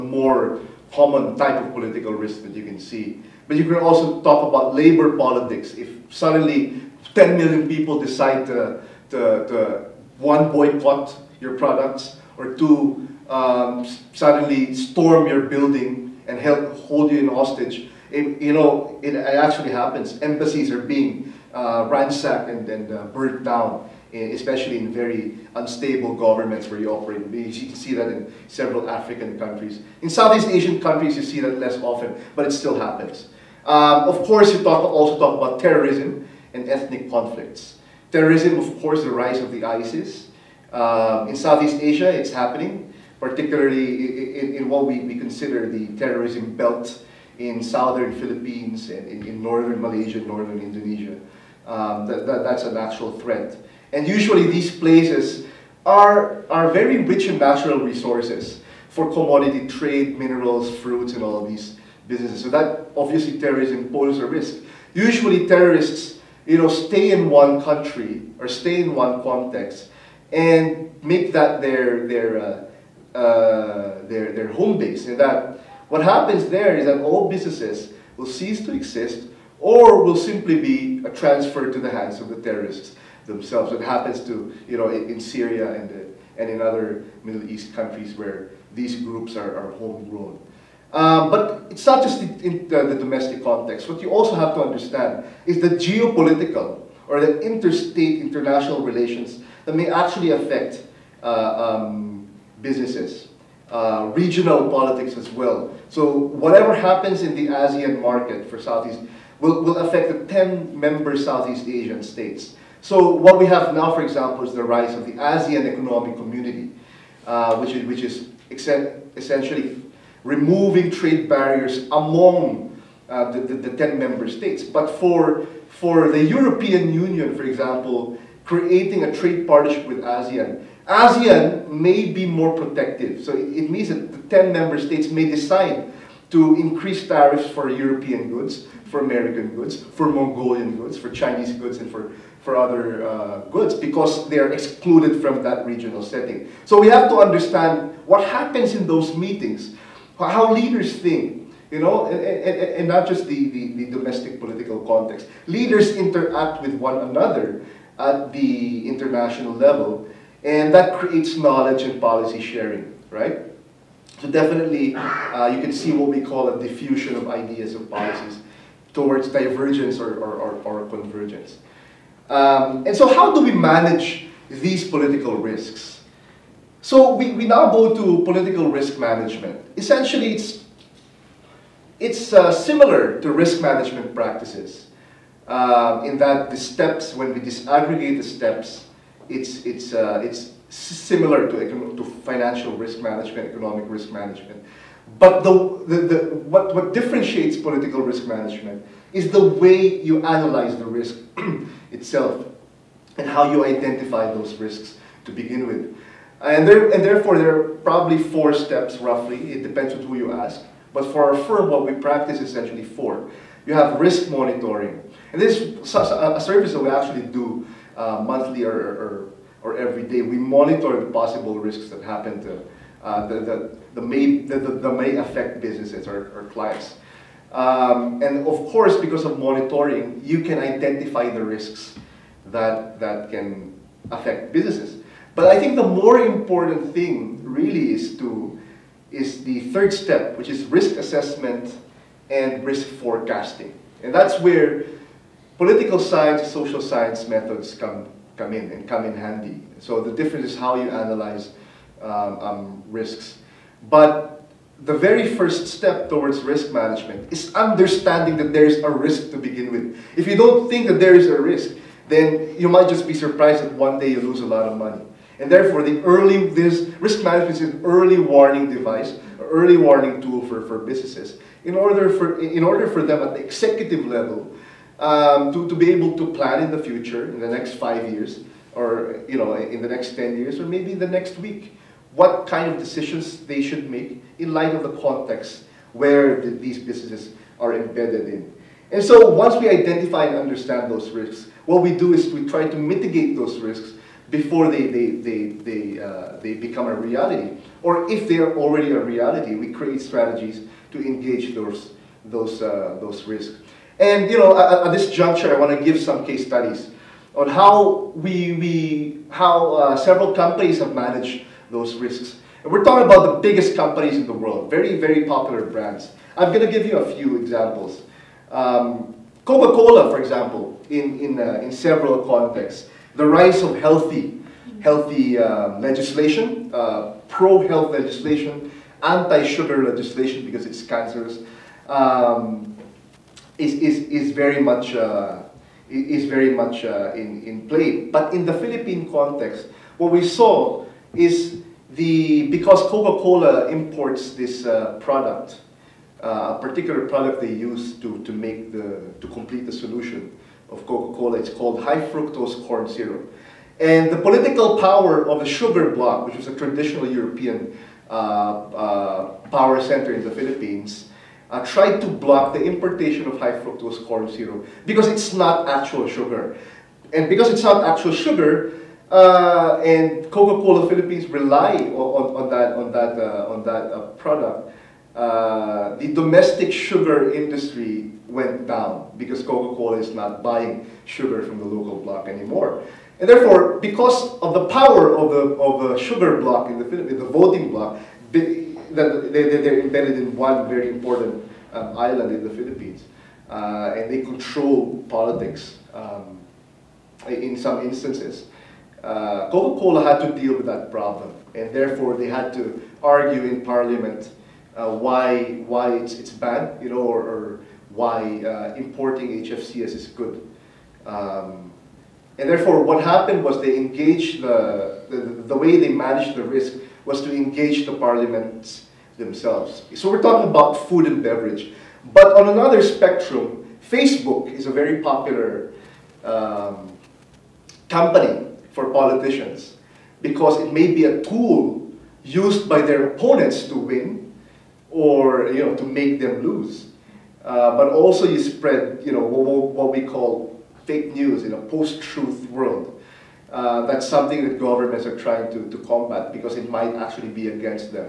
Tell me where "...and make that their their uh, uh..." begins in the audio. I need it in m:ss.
1:10.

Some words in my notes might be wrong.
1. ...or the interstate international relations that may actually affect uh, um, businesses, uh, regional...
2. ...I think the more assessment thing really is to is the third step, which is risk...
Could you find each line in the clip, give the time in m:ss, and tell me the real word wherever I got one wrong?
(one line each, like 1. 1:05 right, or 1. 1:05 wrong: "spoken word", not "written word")
1. 1:37 right
2. 3:55 wrong: "important", not "assessment".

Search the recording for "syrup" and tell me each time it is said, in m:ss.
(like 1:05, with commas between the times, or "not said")
5:52, 6:04.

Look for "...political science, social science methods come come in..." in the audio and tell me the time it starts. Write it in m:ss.
4:05.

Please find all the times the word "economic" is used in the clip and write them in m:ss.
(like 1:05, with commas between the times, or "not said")
1:55, 3:13.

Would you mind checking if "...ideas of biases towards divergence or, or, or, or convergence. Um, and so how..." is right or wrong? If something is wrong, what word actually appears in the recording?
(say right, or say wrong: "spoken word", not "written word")
right.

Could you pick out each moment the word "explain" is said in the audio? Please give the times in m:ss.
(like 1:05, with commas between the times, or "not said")
not said.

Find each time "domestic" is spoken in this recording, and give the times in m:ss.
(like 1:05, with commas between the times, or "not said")
1:32, 2:33, 6:16.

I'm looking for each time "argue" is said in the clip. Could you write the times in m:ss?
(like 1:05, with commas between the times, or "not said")
6:43.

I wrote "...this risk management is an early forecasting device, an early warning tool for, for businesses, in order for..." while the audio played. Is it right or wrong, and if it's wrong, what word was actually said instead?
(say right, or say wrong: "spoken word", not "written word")
wrong: "warning", not "forecasting".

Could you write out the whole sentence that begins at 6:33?
Uh, and they control politics um, in some instances.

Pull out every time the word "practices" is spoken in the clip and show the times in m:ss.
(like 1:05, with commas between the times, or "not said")
3:04, 3:32.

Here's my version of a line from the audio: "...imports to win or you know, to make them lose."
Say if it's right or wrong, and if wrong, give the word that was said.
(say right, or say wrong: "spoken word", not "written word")
wrong: "opponents", not "imports".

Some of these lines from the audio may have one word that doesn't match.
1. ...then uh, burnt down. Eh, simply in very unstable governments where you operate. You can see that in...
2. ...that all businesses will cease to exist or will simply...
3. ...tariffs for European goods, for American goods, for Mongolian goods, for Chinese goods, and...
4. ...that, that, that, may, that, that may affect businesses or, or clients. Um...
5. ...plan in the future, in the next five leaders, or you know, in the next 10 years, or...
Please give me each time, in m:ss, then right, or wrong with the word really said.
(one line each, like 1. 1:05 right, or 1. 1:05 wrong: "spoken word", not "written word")
1. 0:22 wrong: "especially", not "simply"
2. 1:16 right
3. 2:17 right
4. 3:43 right
5. 4:36 wrong: "years", not "leaders".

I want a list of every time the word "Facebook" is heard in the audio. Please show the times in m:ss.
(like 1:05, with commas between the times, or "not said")
7:03.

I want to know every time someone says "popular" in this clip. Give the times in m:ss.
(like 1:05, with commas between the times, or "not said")
5:15, 7:05.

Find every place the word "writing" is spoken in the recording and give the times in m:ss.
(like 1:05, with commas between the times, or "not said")
not said.